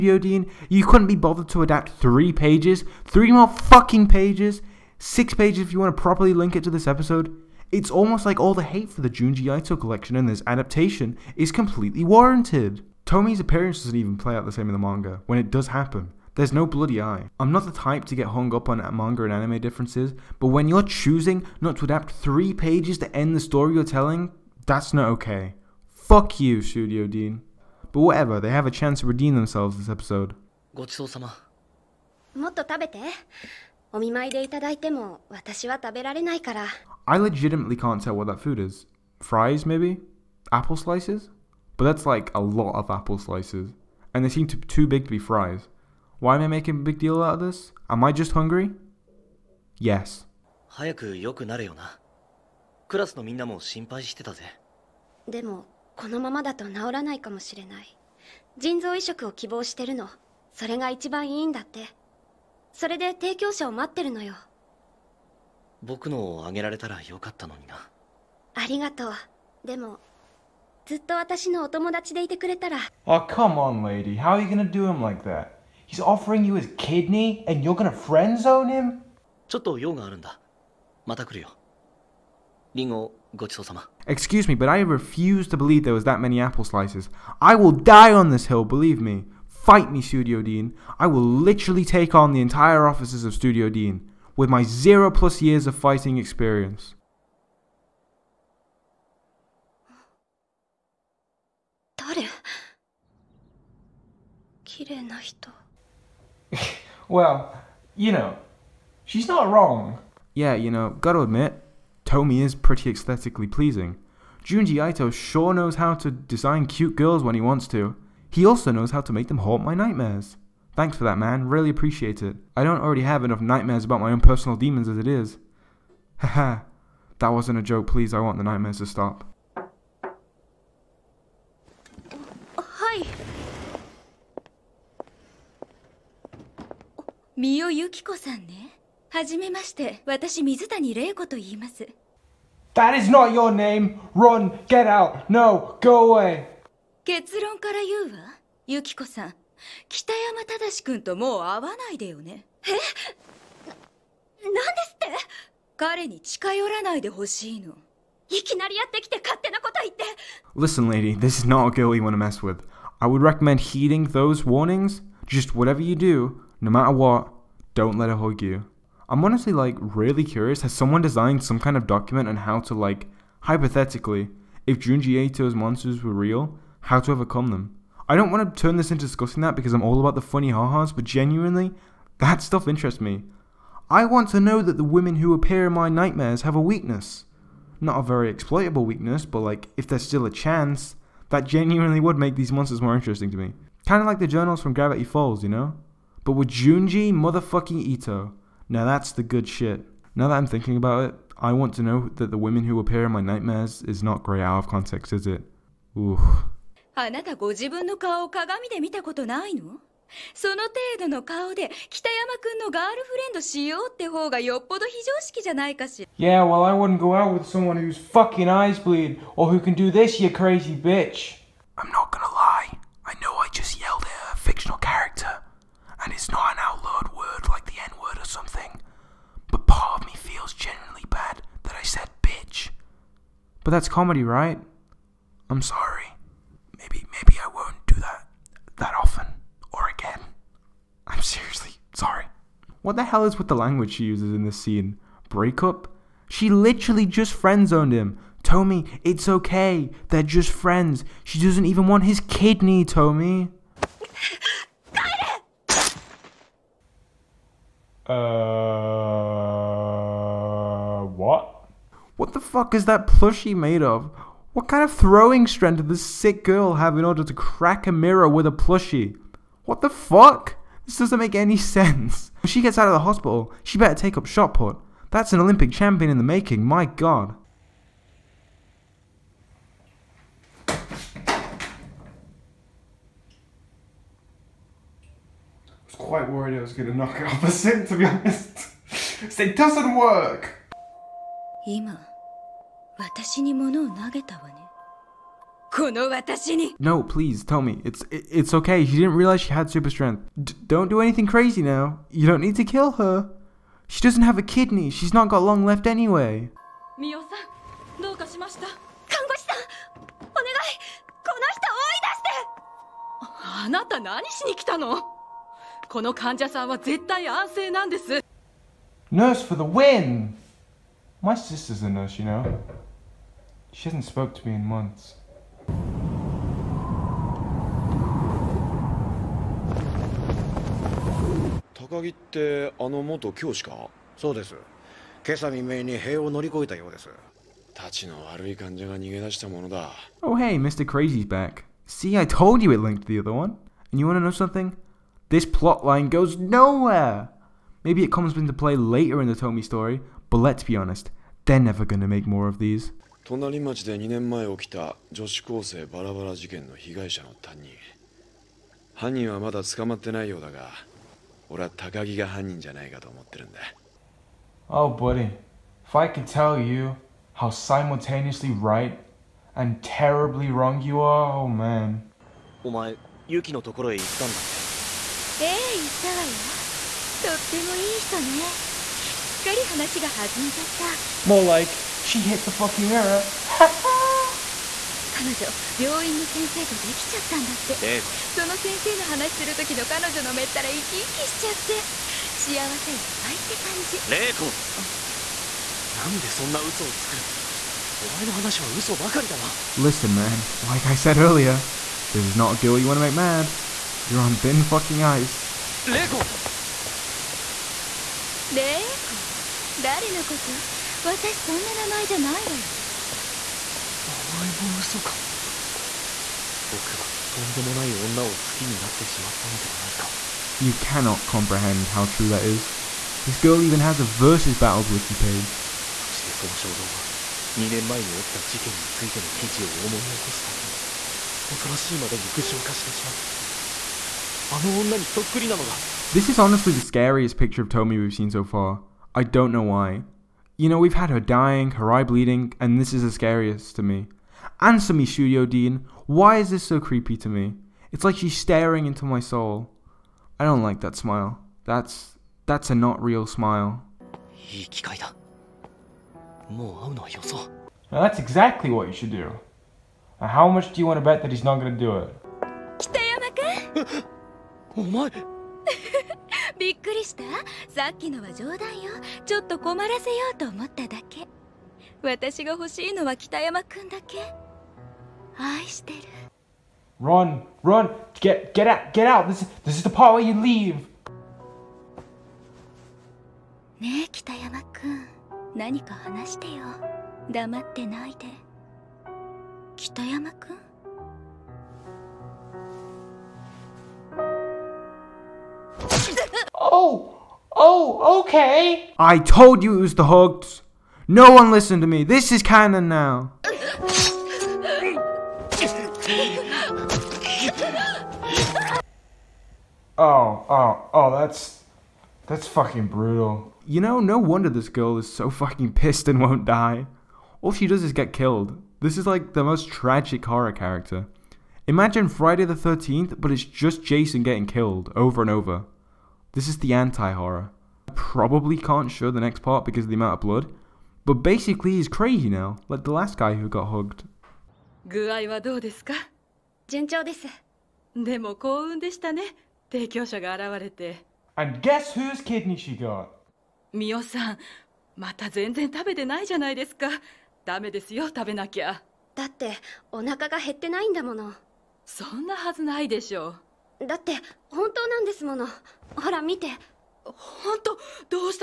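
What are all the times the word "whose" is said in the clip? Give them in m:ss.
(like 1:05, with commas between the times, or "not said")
3:37, 9:01.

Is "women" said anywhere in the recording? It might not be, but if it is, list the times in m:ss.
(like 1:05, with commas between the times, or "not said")
3:04, 3:22.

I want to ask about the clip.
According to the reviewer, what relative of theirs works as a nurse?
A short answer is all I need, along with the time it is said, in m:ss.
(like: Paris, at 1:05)
Sister, at 5:21.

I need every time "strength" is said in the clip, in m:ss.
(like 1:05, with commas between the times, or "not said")
4:25, 4:59.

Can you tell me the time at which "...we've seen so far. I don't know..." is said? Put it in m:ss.
7:17.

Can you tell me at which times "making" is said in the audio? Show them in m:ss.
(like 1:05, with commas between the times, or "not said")
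0:46, 4:36.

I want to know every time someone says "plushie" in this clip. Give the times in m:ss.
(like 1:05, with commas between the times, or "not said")
4:23, 4:28.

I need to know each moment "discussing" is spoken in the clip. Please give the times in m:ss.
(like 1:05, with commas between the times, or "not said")
2:59.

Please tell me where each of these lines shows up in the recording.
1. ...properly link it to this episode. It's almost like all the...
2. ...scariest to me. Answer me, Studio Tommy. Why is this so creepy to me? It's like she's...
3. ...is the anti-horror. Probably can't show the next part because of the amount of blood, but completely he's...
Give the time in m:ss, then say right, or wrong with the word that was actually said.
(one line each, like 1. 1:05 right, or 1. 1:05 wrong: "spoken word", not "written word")
1. 0:06 right
2. 7:23 wrong: "Deen", not "Tommy"
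3. 8:46 wrong: "basically", not "completely".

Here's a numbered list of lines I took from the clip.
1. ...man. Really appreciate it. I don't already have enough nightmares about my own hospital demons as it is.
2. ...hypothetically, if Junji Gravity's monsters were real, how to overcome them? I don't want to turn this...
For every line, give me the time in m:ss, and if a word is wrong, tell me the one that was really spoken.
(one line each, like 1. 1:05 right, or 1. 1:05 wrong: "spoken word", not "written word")
1. 2:01 wrong: "personal", not "hospital"
2. 2:53 wrong: "Ito", not "Gravity".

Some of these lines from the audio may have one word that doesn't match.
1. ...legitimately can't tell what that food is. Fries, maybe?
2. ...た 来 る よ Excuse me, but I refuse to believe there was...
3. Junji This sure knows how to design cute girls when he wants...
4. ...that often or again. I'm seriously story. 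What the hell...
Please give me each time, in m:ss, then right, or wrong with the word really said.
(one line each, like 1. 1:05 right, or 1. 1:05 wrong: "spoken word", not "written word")
1. 0:37 right
2. 1:21 right
3. 1:54 wrong: "Ito", not "This"
4. 3:58 wrong: "sorry", not "story".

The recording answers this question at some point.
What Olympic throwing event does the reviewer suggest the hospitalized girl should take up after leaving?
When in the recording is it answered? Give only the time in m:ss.
4:34.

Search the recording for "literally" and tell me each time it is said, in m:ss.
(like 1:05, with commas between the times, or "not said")
1:31, 4:06.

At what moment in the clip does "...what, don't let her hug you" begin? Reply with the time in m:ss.
2:46.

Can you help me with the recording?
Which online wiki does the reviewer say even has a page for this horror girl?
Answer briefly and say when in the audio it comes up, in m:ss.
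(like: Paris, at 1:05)
Versus battles wiki, at 7:04.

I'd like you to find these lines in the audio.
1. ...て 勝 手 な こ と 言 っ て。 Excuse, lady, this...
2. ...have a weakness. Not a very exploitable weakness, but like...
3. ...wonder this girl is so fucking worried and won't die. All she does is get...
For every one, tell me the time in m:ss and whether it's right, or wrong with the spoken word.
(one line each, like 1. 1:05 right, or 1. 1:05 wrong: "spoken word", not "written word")
1. 2:39 wrong: "Listen", not "Excuse"
2. 3:06 right
3. 8:34 wrong: "pissed", not "worried".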